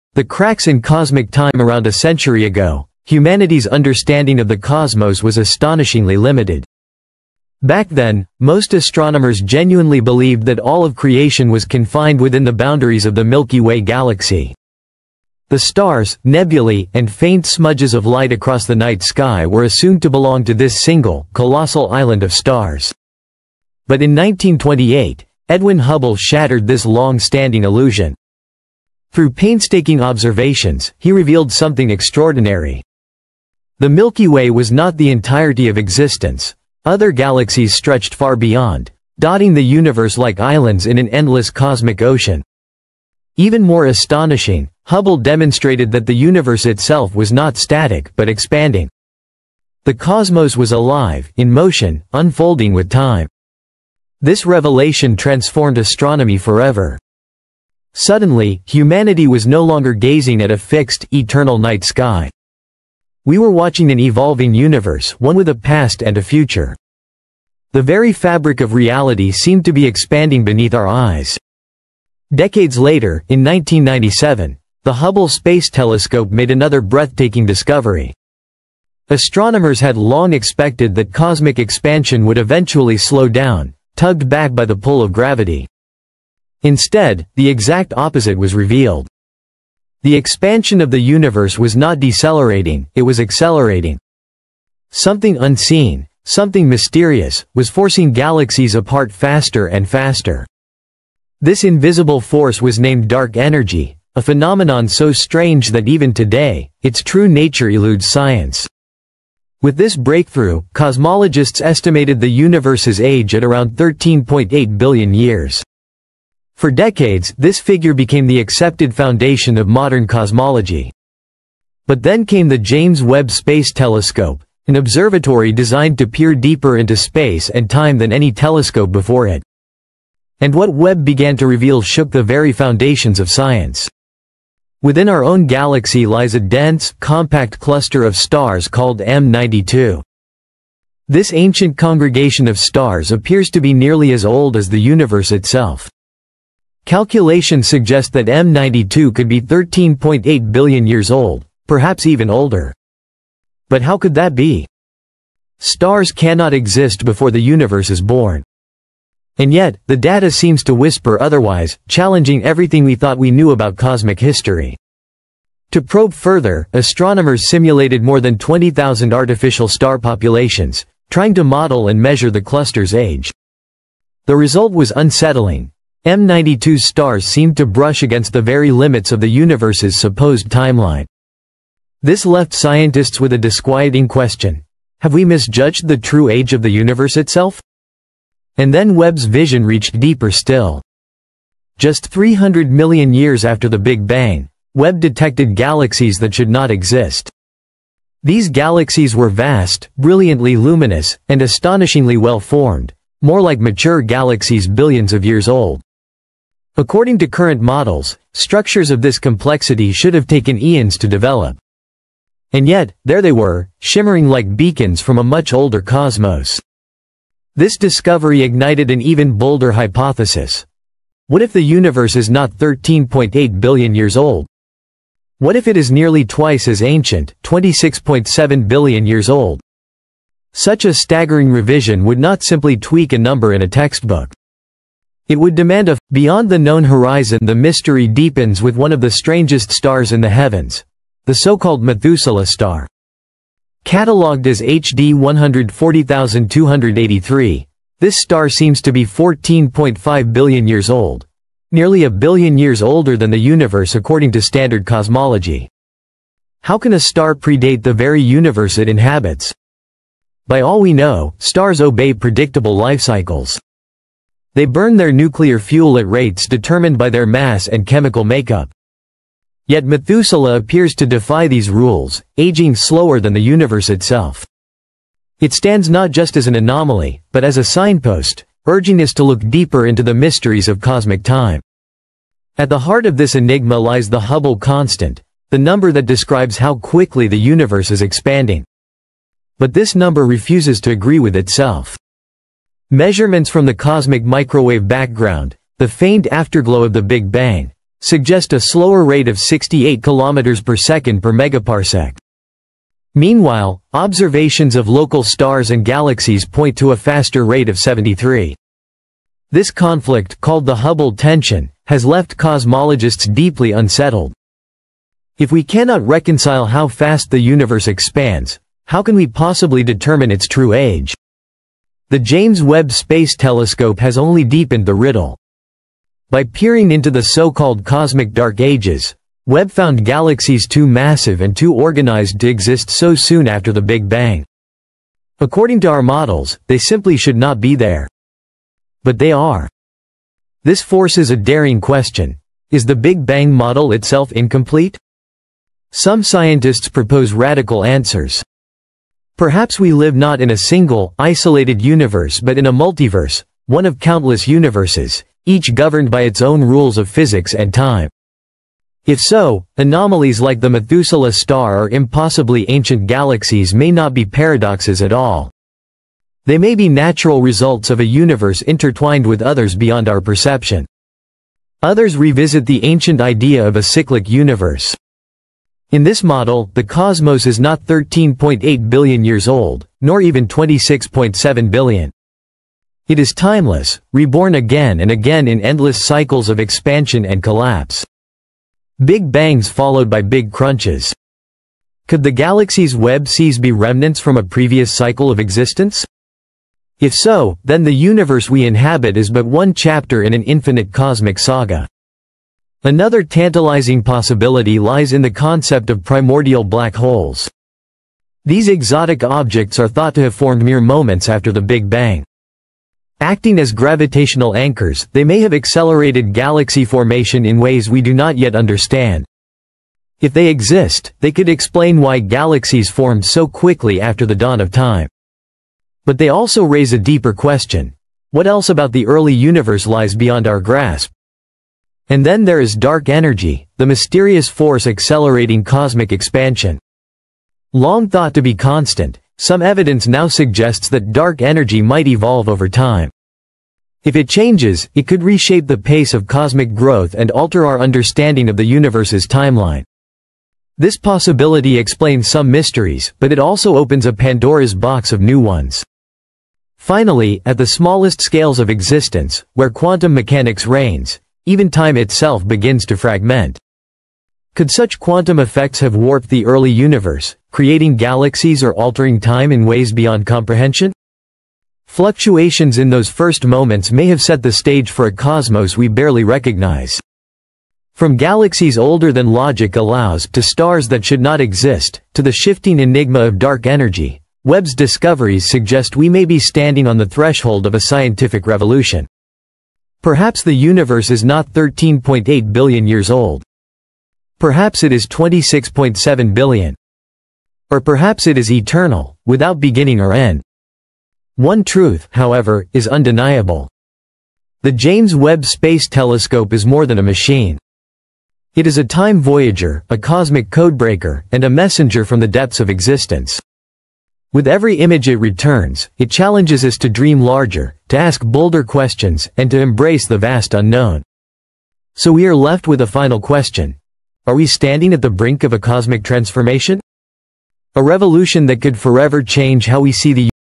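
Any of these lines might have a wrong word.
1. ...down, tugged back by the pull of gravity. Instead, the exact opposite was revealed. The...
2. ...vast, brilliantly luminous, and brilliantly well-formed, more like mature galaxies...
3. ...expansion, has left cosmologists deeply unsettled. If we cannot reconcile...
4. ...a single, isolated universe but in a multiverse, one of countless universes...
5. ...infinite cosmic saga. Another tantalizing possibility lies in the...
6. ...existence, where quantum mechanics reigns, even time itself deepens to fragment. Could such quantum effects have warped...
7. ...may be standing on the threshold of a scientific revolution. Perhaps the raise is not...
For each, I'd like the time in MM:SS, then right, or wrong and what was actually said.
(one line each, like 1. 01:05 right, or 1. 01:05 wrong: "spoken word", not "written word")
1. 01:23 right
2. 03:19 wrong: "astonishingly", not "brilliantly"
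3. 05:11 wrong: "tension", not "expansion"
4. 05:50 right
5. 06:40 right
6. 07:38 wrong: "begins", not "deepens"
7. 08:06 wrong: "universe", not "raise".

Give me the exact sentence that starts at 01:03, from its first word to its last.
We were watching an evolving universe, one with a past and a future.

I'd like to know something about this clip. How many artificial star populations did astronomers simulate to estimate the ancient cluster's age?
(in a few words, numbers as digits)
20,000.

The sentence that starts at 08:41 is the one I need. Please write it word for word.
So we are left with a final question.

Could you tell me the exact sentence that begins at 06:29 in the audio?
Big bangs followed by big crunches.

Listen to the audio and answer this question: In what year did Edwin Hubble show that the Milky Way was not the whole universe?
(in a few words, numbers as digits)
1928.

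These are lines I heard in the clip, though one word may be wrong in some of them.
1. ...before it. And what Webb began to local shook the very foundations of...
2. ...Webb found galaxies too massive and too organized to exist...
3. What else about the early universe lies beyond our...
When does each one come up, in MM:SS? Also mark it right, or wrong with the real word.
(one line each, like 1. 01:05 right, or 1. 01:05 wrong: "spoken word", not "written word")
1. 02:08 wrong: "reveal", not "local"
2. 05:29 right
3. 07:08 right.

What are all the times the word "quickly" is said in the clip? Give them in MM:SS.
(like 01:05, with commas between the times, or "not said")
04:46, 07:03.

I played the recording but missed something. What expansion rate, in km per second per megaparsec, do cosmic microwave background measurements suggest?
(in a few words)
68.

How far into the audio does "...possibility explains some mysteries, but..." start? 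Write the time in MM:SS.
07:30.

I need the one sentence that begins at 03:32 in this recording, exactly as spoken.
And yet, there they were, shimmering like beacons from a much older cosmos.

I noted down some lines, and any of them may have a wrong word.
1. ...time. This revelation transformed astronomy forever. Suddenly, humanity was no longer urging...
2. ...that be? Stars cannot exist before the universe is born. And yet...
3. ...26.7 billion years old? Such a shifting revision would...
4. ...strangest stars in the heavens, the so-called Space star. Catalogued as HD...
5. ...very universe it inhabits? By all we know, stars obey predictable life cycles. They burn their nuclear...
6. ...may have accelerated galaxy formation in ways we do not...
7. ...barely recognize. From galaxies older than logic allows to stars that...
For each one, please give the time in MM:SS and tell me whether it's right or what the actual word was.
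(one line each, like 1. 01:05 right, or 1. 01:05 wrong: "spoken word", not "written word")
1. 00:52 wrong: "gazing", not "urging"
2. 02:34 right
3. 03:47 wrong: "staggering", not "shifting"
4. 03:59 wrong: "Methuselah", not "Space"
5. 04:17 right
6. 06:55 right
7. 07:55 right.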